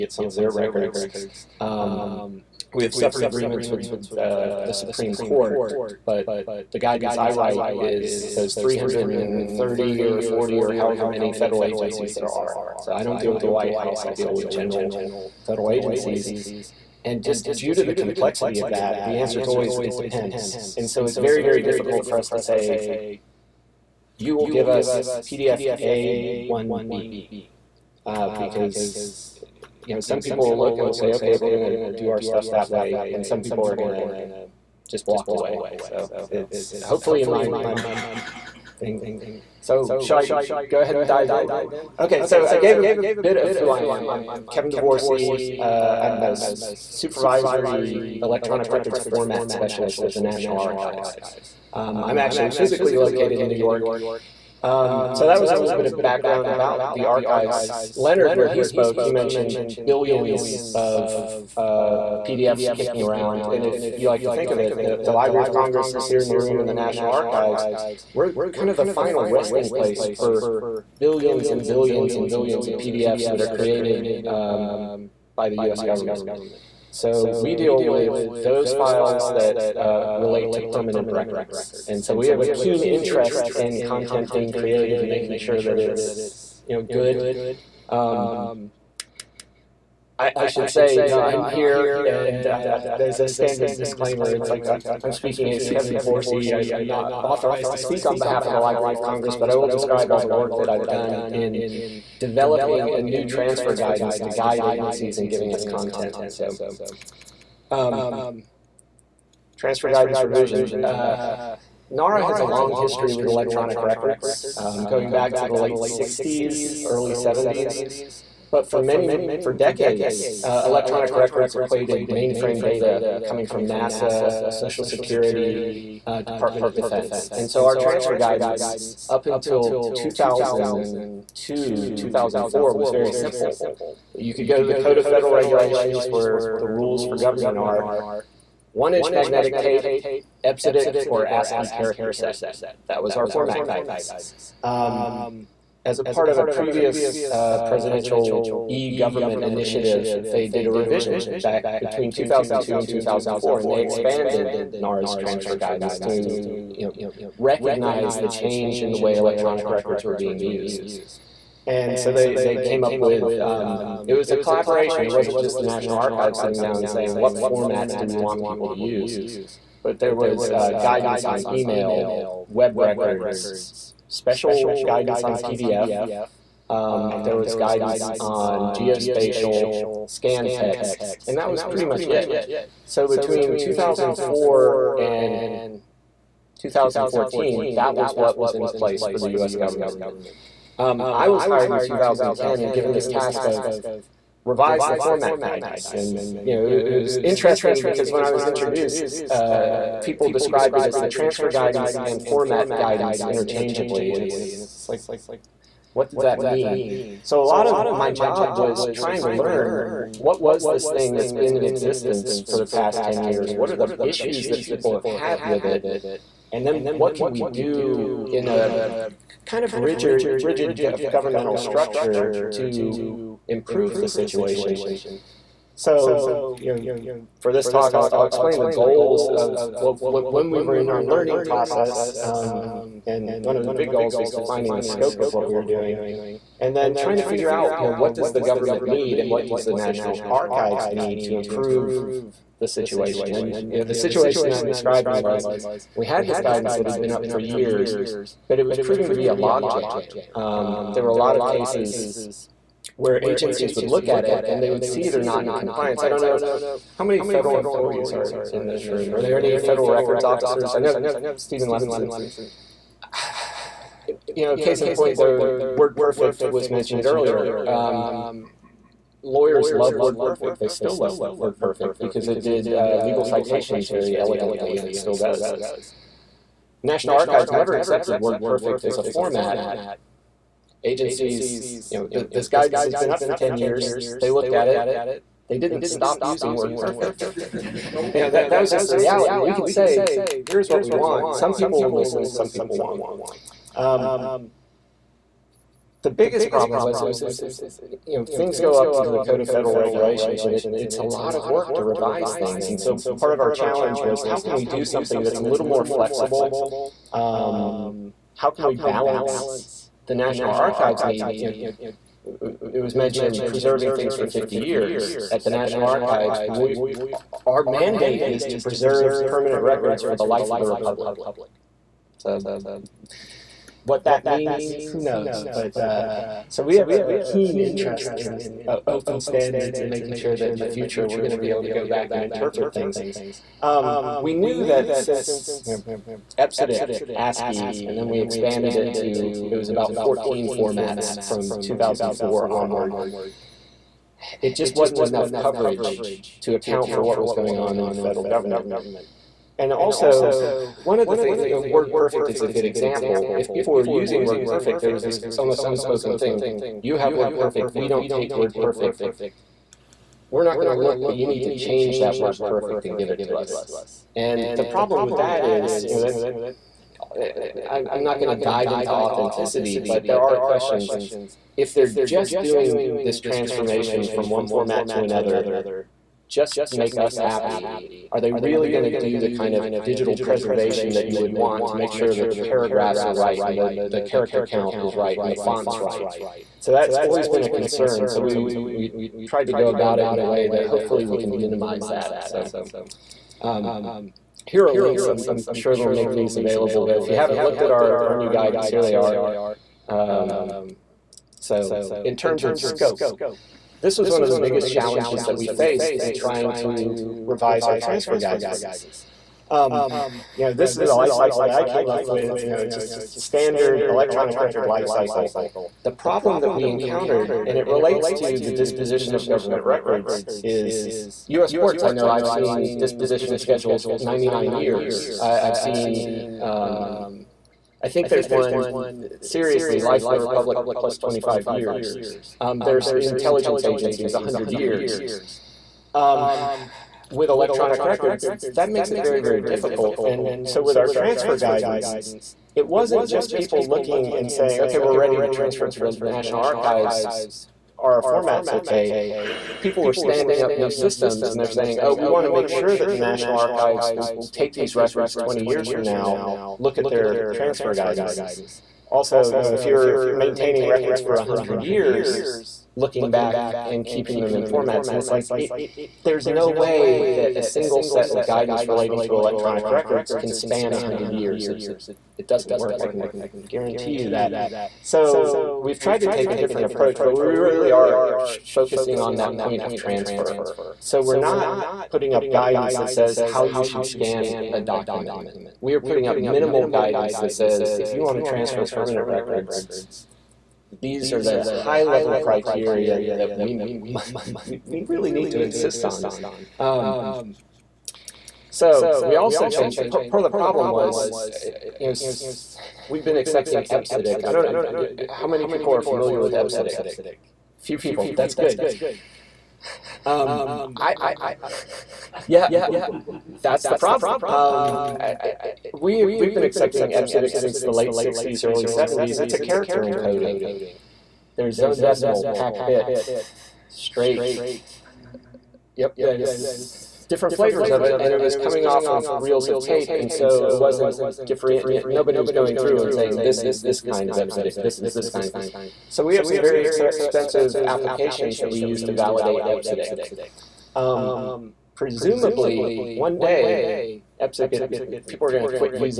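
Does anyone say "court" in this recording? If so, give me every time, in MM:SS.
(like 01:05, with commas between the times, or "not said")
00:05, 07:01.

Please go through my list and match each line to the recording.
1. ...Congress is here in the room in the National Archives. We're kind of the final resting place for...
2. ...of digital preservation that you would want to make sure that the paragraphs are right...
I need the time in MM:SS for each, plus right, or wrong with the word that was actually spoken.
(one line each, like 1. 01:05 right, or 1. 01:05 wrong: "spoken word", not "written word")
1. 01:05 right
2. 06:19 right.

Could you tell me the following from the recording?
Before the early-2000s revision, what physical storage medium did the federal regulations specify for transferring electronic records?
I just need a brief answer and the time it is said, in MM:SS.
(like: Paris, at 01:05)
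One inch magnetic tape, at 02:18.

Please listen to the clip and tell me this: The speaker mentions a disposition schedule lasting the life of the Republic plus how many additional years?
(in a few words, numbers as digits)
25 years.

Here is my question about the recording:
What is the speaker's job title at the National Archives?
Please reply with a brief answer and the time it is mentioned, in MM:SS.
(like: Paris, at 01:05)
Supervisory electronic records format specialist, at 00:46.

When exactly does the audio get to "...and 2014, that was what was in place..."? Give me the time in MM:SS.
03:04.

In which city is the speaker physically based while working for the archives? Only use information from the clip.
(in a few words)
New York.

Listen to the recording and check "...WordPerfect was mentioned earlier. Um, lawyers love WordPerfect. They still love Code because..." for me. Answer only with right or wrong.
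wrong.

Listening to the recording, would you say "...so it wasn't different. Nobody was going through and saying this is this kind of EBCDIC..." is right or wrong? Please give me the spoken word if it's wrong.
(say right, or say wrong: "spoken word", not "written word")
right.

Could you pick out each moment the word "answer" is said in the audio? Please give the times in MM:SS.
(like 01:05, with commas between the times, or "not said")
00:19.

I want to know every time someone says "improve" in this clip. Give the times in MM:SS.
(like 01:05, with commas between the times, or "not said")
03:43, 04:01.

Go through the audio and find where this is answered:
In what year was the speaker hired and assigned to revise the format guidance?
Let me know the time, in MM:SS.
03:11.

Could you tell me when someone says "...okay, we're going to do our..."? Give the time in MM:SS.
00:31.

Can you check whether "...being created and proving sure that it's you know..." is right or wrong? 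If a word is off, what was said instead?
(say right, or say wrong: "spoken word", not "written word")
wrong: "making", not "proving".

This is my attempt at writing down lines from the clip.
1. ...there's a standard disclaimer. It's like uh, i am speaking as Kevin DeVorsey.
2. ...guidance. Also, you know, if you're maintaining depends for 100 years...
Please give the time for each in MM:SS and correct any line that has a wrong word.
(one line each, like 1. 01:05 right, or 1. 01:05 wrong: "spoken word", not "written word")
1. 01:32 right
2. 07:37 wrong: "records", not "depends".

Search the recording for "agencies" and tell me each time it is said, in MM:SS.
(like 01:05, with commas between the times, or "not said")
00:11, 00:15, 01:44, 04:13, 04:40, 07:13.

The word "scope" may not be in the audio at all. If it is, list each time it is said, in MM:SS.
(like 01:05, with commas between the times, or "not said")
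03:54, 06:42.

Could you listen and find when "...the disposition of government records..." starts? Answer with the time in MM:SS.
06:58.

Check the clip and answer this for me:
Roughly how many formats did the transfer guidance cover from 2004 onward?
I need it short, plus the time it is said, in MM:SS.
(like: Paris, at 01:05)
14, at 05:39.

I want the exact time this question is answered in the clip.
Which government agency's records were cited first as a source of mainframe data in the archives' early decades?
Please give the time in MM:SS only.
02:03.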